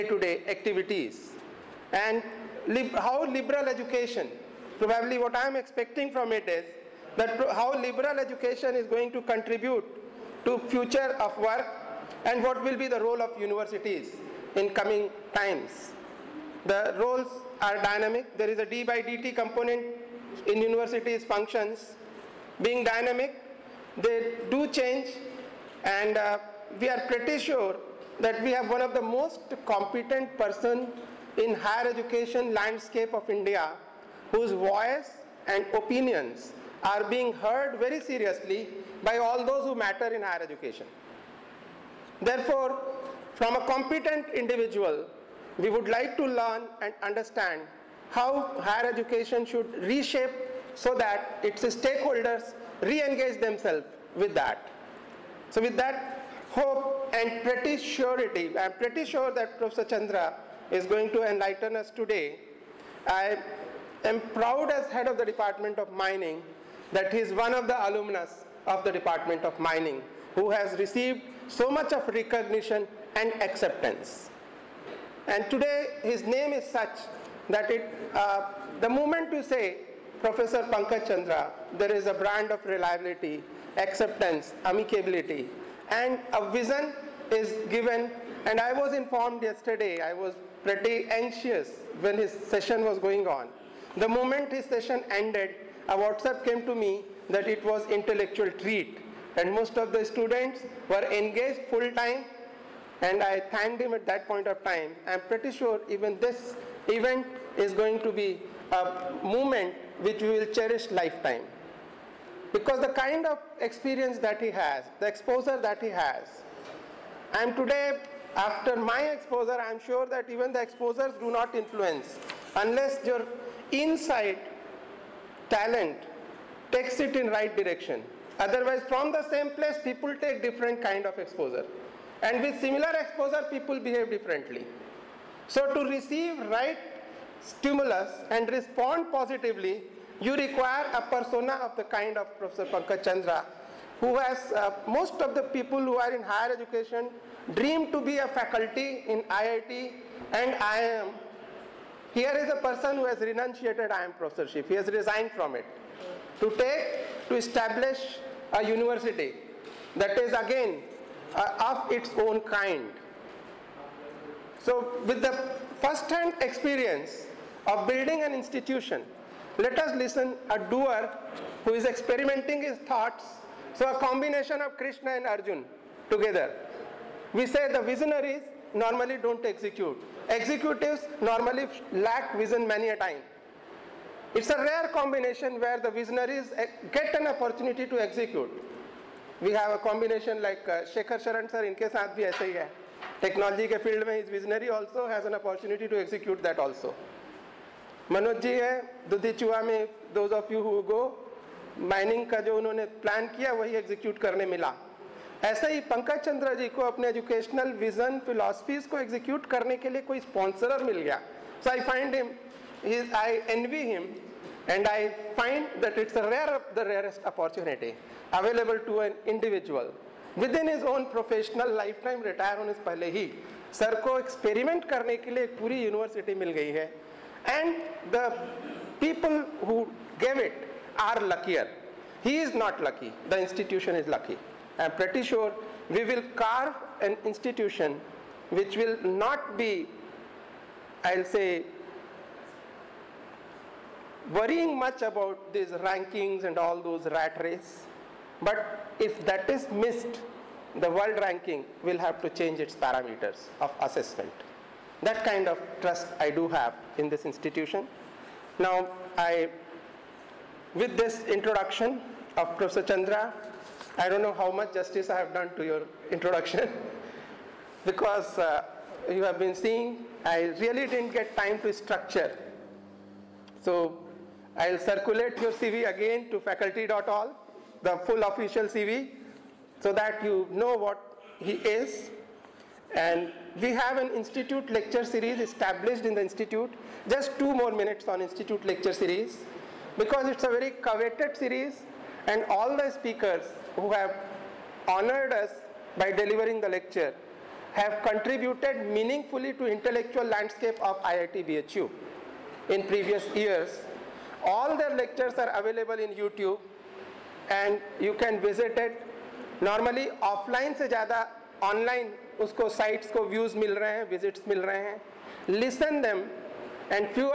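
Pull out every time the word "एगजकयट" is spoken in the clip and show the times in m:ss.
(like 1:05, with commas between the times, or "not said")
3:15, 3:23, 3:28.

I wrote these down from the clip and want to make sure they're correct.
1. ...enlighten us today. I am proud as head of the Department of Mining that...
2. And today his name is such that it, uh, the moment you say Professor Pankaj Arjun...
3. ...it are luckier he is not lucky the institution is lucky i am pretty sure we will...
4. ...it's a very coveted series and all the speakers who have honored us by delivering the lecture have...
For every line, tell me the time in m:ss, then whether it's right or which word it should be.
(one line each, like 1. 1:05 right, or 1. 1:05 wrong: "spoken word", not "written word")
1. 1:01 right
2. 1:15 wrong: "Chandra", not "Arjun"
3. 3:50 right
4. 4:50 right.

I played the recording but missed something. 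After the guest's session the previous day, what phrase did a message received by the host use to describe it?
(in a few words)
intellectual treat.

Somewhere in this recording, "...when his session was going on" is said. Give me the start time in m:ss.
1:32.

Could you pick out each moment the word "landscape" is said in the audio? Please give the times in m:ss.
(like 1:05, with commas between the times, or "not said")
0:32, 5:00.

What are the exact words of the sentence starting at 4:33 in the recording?
So, I'll circulate your CV again to faculty.all the full official CV so that you know what he is.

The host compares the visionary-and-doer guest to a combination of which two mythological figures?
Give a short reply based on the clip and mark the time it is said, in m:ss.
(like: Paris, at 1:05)
Krishna and Arjun, at 2:54.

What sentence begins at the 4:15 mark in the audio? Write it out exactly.
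That kind of trust I do have in this institution.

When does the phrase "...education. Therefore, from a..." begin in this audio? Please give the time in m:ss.
0:40.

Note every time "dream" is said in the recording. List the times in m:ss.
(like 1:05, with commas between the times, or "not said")
2:27.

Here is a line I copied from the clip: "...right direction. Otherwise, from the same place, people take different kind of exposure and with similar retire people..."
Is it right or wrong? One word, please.
wrong.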